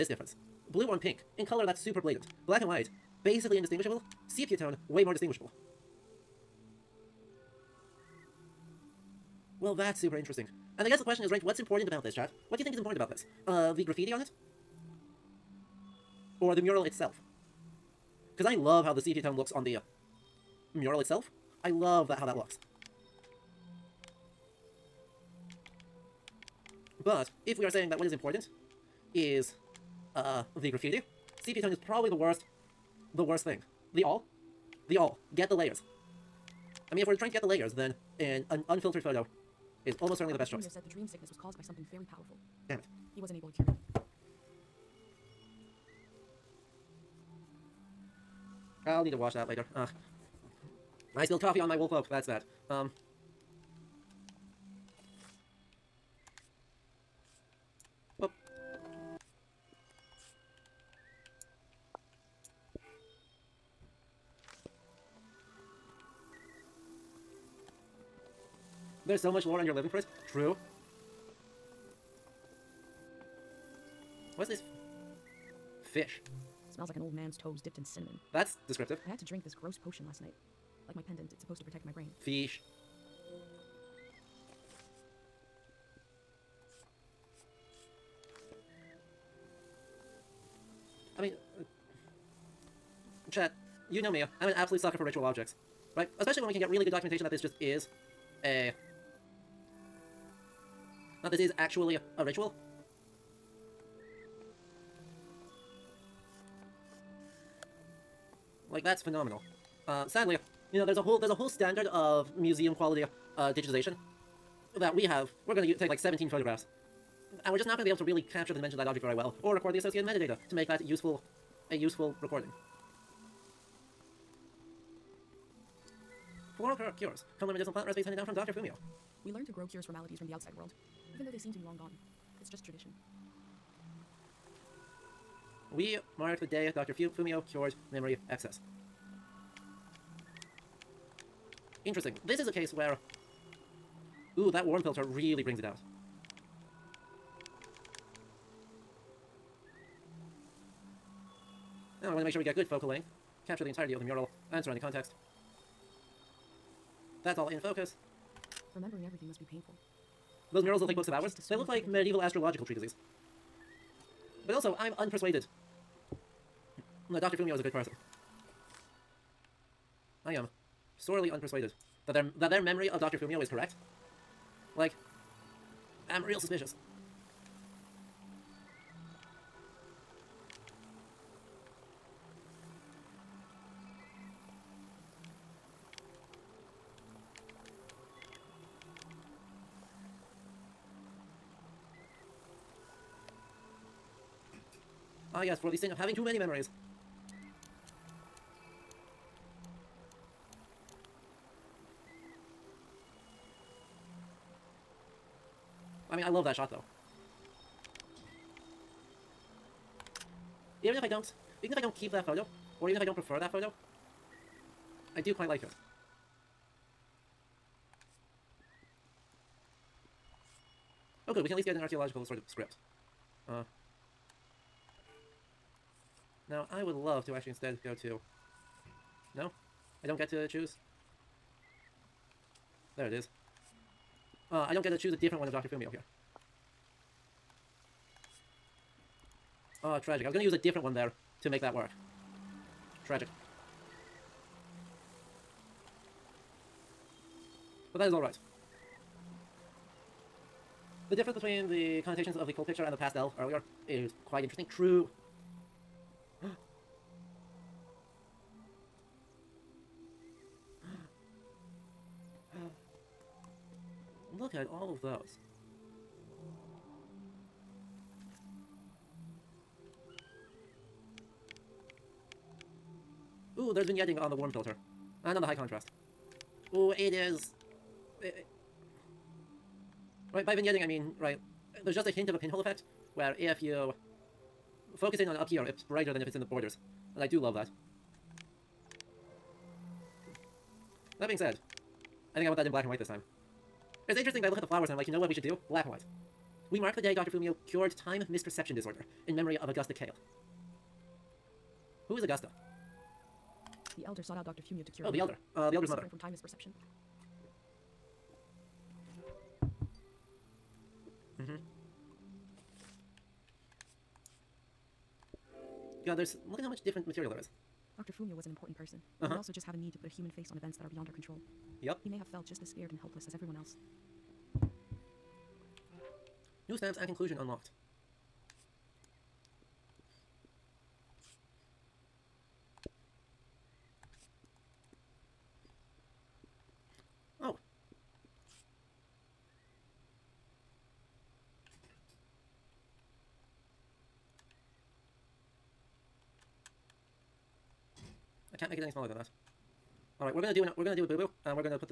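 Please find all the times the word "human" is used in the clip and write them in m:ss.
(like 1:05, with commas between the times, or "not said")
5:20.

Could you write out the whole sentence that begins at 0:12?
What do you think is important about this?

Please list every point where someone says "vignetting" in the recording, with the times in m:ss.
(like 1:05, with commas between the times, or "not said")
4:33, 4:40.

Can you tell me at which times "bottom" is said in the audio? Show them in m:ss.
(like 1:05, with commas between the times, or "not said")
not said.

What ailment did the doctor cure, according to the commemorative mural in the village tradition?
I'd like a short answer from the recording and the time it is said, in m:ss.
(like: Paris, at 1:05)
memory excess, at 2:17.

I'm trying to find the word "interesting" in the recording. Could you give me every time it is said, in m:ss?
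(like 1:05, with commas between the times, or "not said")
0:10, 2:21, 4:14, 4:54.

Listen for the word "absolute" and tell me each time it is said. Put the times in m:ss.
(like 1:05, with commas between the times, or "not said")
1:34.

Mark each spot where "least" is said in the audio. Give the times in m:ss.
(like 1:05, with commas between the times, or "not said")
3:41.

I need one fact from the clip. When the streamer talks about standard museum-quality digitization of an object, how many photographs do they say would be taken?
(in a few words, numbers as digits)
17.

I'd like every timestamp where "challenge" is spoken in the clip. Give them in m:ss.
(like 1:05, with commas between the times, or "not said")
not said.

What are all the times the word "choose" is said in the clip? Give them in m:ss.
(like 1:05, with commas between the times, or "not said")
3:50, 3:54.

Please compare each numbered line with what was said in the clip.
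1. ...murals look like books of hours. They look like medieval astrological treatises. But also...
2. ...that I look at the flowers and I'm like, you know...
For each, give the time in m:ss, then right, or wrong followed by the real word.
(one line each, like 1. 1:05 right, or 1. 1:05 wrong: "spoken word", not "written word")
1. 2:40 right
2. 4:54 right.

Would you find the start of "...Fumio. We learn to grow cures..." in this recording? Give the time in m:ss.
2:08.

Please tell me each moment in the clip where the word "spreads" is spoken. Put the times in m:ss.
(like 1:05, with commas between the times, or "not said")
not said.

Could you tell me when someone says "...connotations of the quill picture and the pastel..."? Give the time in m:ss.
4:12.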